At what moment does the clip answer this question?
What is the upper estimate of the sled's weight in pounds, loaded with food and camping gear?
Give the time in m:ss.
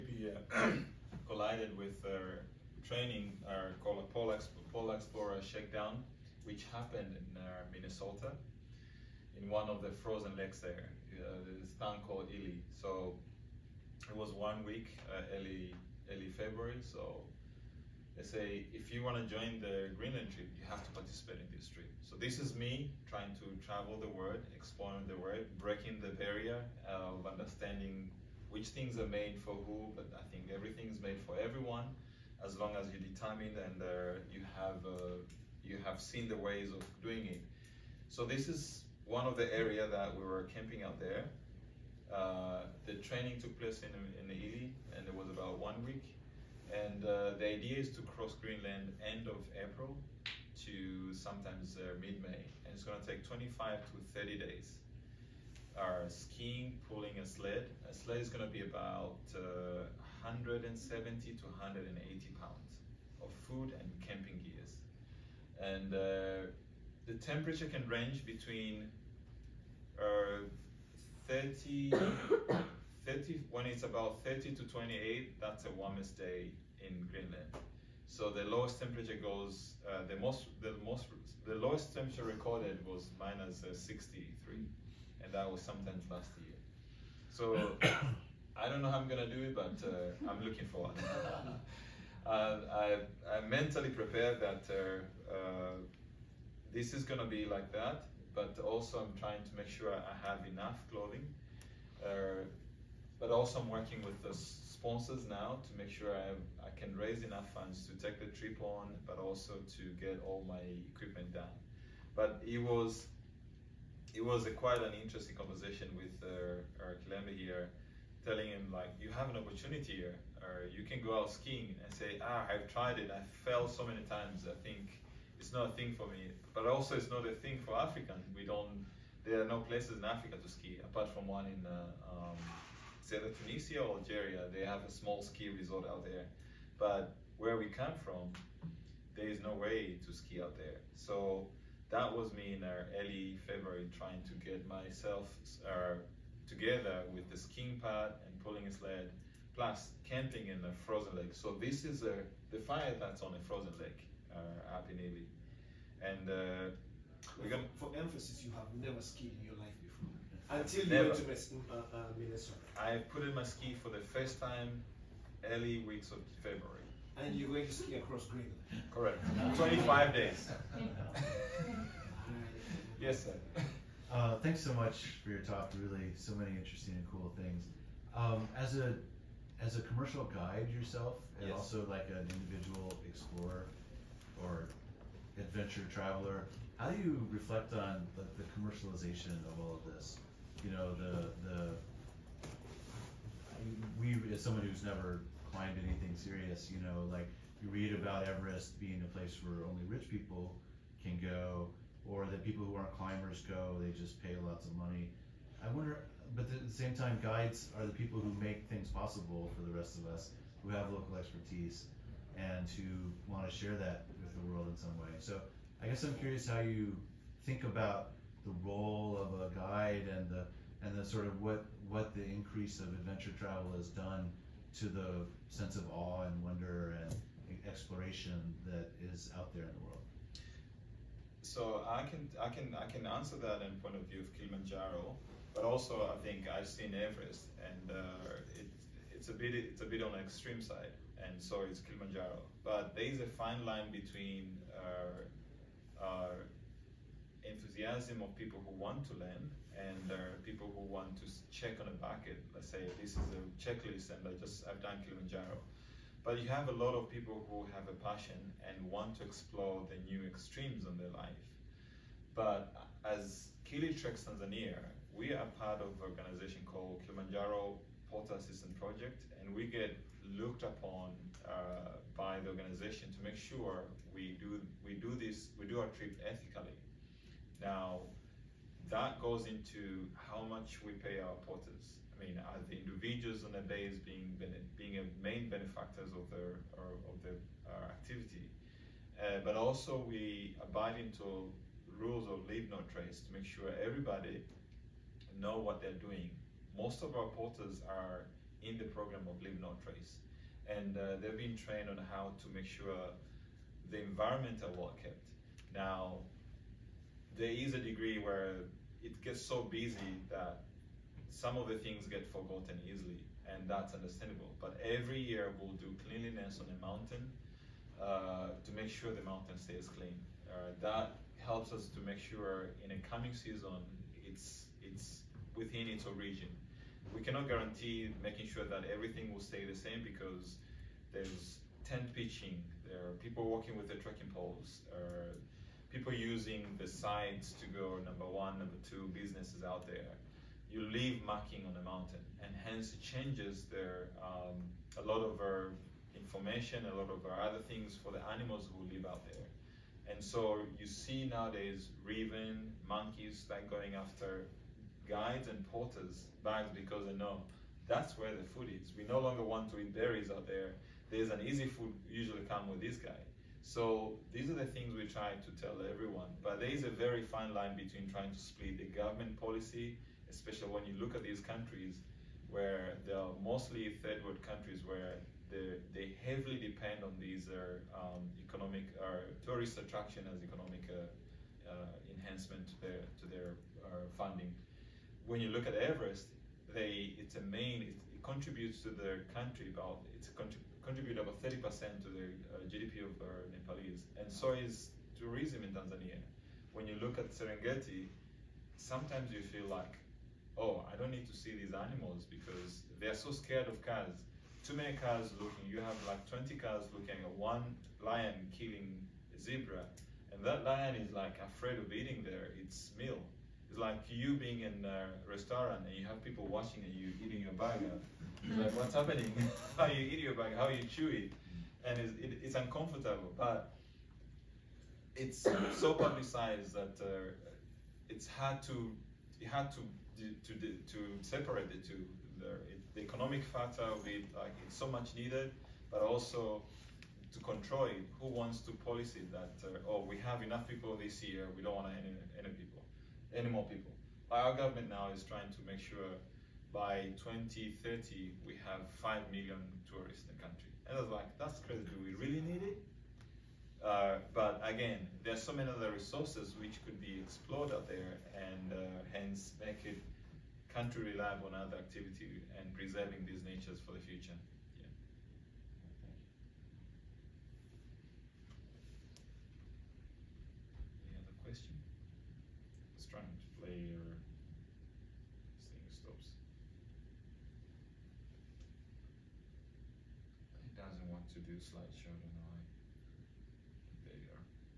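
1:01.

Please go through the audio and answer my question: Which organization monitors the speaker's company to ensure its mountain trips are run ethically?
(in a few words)
Kilimanjaro Porter Assistance Project.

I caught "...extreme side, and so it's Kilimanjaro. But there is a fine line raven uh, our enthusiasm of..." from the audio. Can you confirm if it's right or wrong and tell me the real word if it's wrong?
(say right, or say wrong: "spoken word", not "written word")
wrong: "between", not "raven".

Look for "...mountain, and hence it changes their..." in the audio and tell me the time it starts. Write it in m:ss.
5:41.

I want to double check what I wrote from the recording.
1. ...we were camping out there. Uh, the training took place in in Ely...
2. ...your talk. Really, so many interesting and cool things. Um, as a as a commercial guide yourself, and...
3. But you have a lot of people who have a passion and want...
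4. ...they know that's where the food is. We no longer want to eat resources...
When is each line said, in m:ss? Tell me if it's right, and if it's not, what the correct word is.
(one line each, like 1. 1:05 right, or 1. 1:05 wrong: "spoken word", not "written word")
1. 0:40 right
2. 2:55 right
3. 4:16 right
4. 5:57 wrong: "berries", not "resources".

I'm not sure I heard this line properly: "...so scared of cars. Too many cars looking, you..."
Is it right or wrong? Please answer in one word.
right.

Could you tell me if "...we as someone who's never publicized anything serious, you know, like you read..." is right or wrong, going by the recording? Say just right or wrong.
wrong.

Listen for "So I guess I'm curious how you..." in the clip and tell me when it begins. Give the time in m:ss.
3:35.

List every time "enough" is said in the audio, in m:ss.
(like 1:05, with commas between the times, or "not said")
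1:40, 1:47, 7:20.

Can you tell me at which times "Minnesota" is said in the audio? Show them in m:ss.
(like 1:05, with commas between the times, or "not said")
0:07, 2:42.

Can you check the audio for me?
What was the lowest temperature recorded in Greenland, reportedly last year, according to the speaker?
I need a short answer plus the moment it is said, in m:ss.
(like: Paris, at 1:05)
-63, at 1:23.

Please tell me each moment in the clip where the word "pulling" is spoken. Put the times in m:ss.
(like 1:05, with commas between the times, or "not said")
0:56, 2:28.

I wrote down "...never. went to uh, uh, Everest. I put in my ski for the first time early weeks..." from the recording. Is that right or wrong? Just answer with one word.
wrong.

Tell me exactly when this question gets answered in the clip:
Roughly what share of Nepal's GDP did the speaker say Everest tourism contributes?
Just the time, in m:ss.
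6:31.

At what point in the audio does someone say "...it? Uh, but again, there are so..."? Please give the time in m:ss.
7:32.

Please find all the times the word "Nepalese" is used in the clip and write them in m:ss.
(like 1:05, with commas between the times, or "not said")
6:33.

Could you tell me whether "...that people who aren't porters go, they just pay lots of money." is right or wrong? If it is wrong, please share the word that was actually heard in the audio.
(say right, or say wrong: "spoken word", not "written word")
wrong: "climbers", not "porters".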